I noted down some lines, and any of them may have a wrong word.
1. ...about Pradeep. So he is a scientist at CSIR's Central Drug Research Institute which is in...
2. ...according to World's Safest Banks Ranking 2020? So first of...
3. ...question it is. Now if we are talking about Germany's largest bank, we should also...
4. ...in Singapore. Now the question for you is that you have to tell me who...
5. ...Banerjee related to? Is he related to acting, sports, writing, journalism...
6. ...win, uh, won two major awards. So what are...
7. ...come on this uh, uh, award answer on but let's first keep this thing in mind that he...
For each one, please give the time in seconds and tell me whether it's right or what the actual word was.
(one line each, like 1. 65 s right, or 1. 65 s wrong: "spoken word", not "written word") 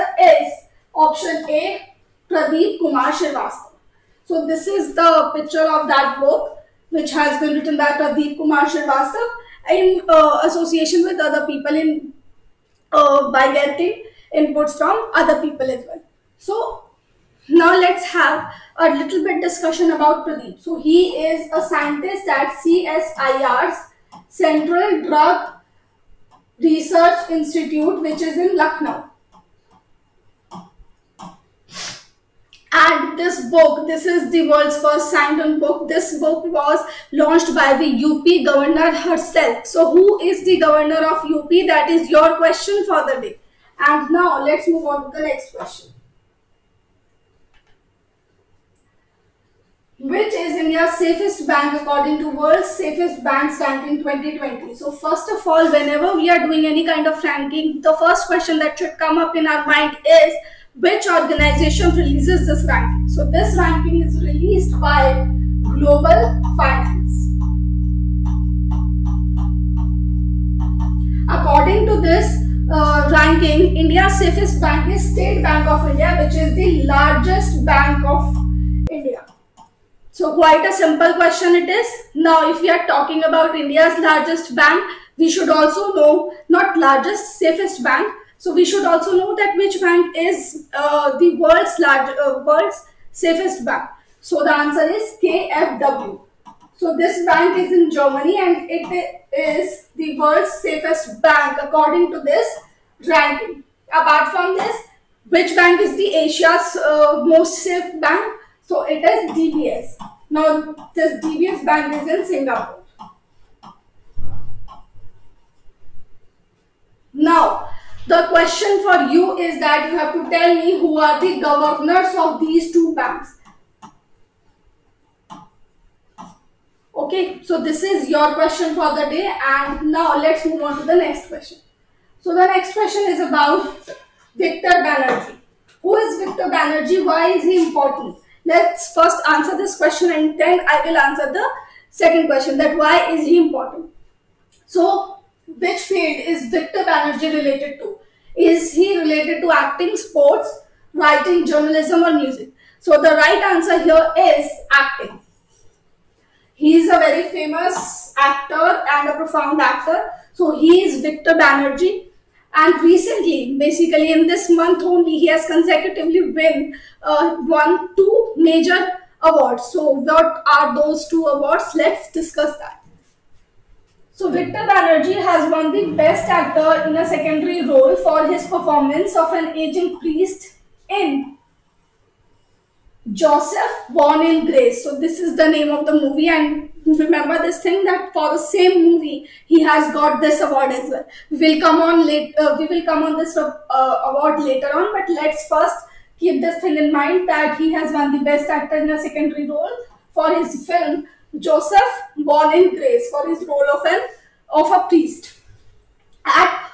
1. 19 s right
2. 51 s right
3. 81 s wrong: "India", not "Germany"
4. 112 s right
5. 146 s right
6. 166 s right
7. 192 s wrong: "later", not "answer".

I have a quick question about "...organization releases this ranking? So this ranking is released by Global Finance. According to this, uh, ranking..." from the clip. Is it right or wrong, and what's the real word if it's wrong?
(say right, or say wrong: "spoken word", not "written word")
right.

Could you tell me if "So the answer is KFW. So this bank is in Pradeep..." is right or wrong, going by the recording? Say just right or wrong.
wrong.